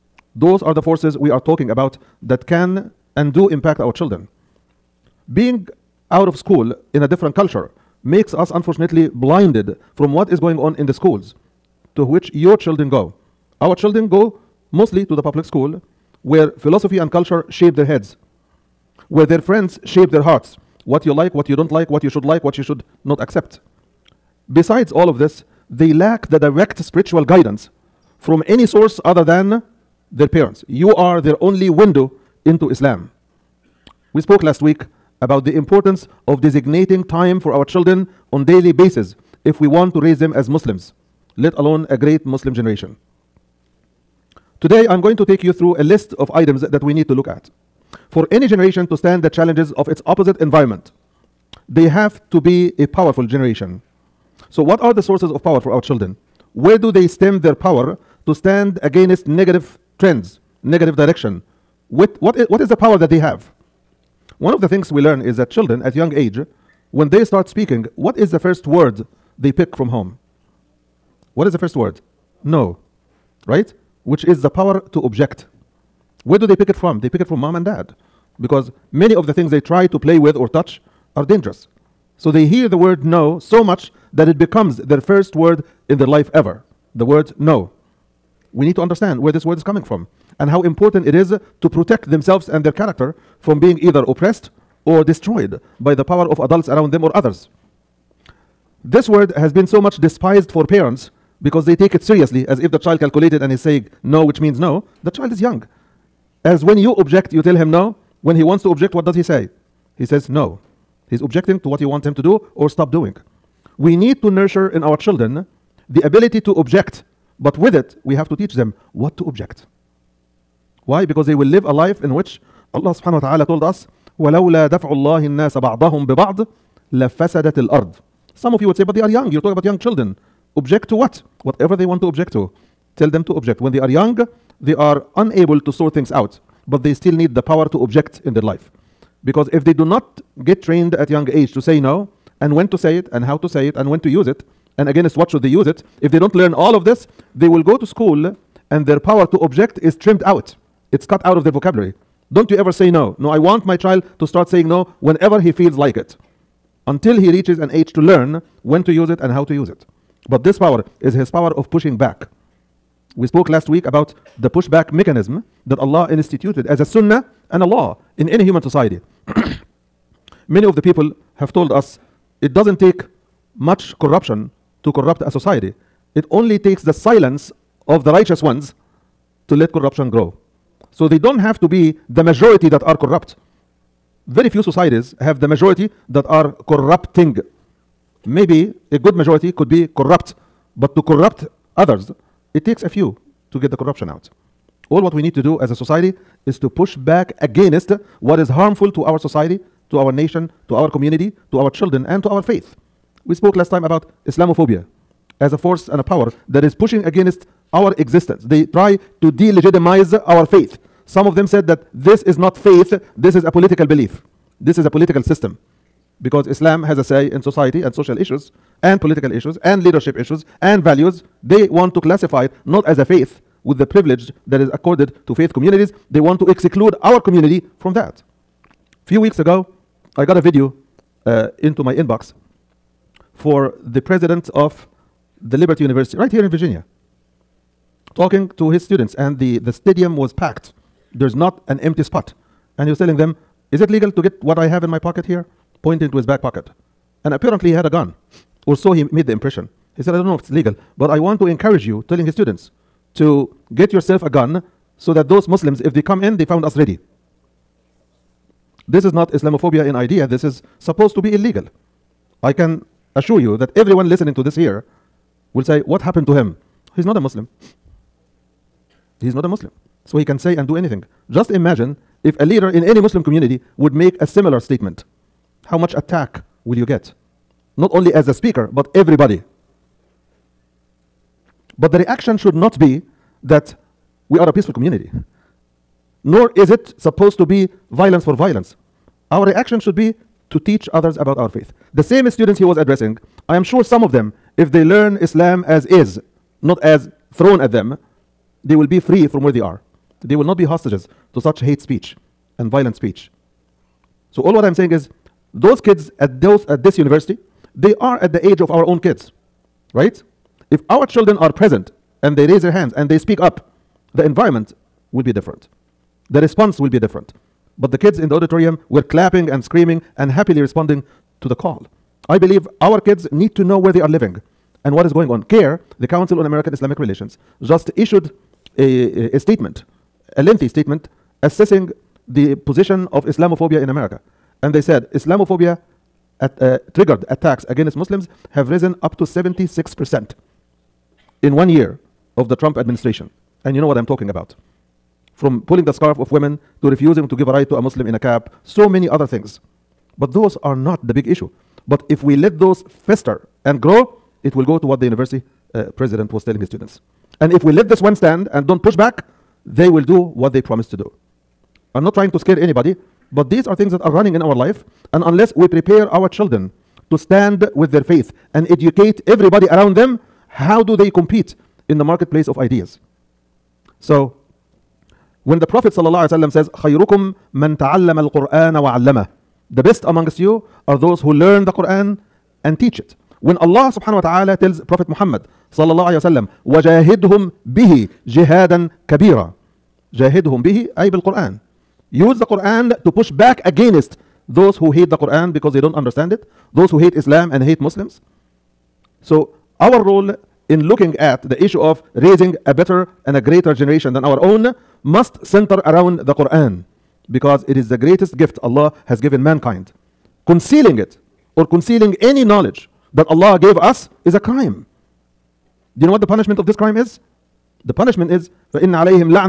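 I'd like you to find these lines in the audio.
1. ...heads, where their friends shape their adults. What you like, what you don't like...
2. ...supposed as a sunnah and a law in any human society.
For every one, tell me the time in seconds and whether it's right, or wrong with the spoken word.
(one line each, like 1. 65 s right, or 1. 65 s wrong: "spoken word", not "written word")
1. 17 s wrong: "hearts", not "adults"
2. 166 s wrong: "instituted", not "supposed".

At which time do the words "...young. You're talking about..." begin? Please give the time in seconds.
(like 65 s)
129 s.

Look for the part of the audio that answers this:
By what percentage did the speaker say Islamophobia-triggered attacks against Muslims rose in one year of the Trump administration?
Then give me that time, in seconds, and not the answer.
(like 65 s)
339 s.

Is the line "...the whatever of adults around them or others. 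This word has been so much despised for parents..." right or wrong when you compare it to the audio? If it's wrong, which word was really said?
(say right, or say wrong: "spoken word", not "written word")
wrong: "power", not "whatever".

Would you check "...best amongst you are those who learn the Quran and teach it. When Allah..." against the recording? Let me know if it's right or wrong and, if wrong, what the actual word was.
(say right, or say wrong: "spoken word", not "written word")
right.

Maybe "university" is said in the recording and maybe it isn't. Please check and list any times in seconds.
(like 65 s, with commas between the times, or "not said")
235 s, 306 s, 355 s.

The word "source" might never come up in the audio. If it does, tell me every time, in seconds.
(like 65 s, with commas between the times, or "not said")
28 s, 55 s.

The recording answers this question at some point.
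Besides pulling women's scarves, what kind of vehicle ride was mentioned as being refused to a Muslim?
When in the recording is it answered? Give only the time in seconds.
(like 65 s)
348 s.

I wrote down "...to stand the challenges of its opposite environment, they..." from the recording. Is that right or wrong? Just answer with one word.
right.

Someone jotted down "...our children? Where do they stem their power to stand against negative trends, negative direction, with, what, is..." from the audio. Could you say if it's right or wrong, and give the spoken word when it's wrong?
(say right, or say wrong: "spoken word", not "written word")
right.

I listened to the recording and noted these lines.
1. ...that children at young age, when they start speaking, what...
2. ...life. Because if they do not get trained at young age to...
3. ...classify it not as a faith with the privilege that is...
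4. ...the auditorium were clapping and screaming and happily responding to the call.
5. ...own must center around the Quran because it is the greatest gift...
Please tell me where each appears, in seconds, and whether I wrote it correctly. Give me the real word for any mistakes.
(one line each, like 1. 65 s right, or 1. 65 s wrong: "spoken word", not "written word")
1. 65 s right
2. 138 s right
3. 222 s right
4. 318 s right
5. 404 s right.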